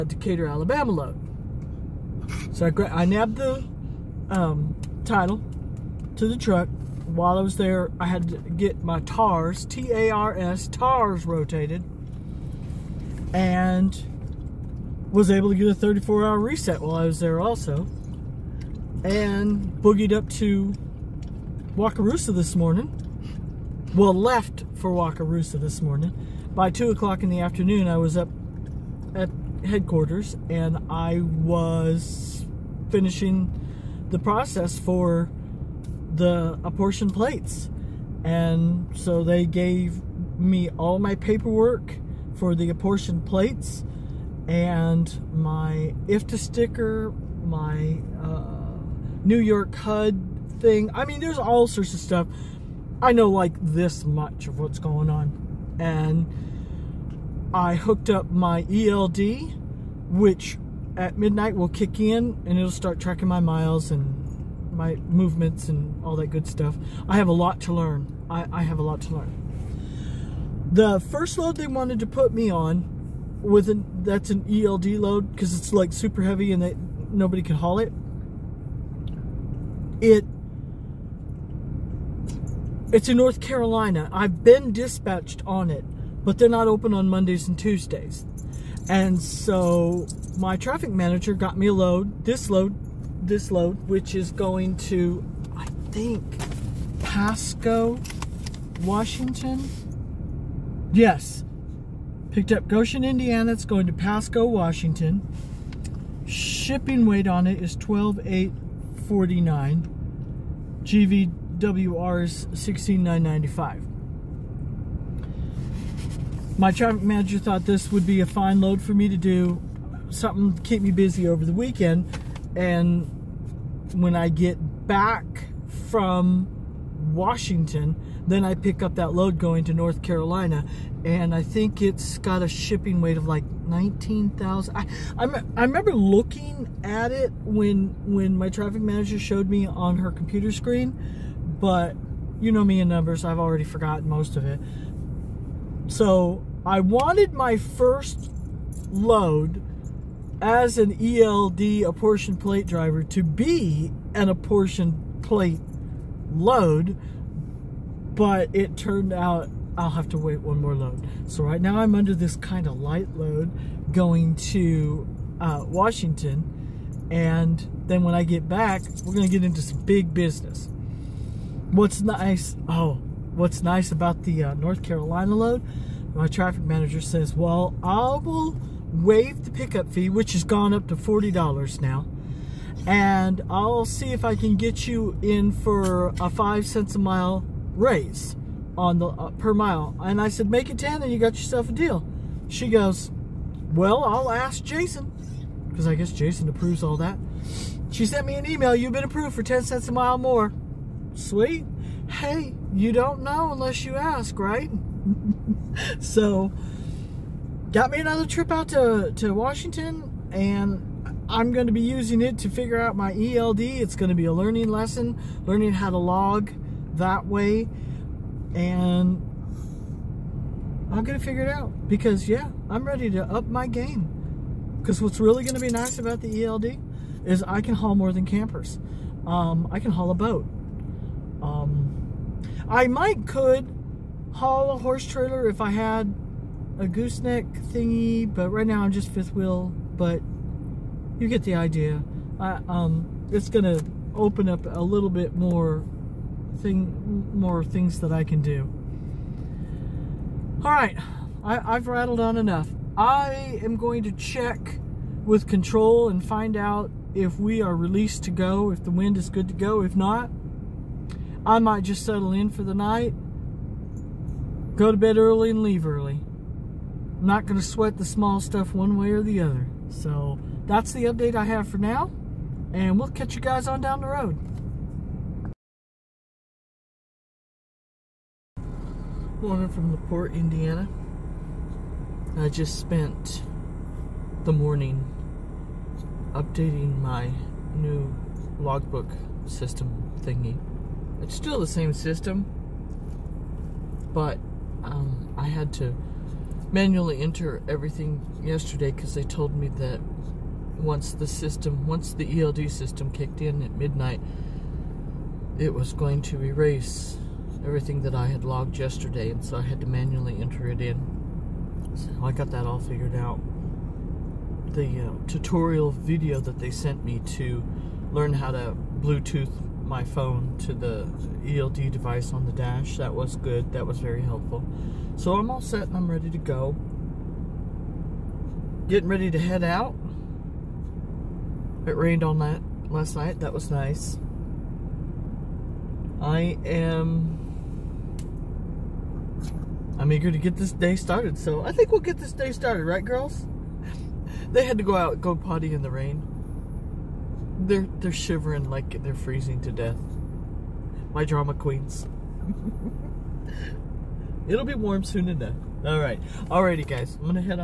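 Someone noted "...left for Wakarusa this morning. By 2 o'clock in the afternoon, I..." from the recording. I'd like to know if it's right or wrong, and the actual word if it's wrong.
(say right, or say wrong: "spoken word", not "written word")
right.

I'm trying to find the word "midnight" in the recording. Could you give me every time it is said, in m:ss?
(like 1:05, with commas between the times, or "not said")
1:01, 5:03.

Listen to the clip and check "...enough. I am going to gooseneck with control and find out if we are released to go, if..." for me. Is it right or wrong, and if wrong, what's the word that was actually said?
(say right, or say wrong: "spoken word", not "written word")
wrong: "check", not "gooseneck".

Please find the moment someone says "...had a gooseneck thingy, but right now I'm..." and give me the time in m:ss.
3:55.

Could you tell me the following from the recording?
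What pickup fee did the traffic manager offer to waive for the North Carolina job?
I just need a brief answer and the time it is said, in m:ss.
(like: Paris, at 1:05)
$40, at 3:00.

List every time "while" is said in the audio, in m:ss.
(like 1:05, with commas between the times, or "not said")
0:07, 0:16.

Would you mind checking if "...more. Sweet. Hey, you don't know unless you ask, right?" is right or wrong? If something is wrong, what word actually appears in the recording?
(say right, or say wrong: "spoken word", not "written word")
right.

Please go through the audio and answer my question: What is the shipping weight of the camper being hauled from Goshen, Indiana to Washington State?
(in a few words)
12,849.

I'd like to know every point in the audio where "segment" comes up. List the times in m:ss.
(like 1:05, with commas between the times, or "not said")
not said.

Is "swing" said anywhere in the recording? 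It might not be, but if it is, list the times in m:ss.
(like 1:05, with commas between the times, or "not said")
not said.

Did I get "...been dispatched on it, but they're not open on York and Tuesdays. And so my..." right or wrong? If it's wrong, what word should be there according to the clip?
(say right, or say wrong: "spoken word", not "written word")
wrong: "Mondays", not "York".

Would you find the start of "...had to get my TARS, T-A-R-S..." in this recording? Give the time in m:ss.
0:08.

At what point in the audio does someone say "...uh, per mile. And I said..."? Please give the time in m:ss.
3:09.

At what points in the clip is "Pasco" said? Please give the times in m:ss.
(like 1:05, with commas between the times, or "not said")
1:36, 1:43.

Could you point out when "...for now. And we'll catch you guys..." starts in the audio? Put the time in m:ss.
4:31.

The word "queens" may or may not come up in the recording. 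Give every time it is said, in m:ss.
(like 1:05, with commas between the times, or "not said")
5:51.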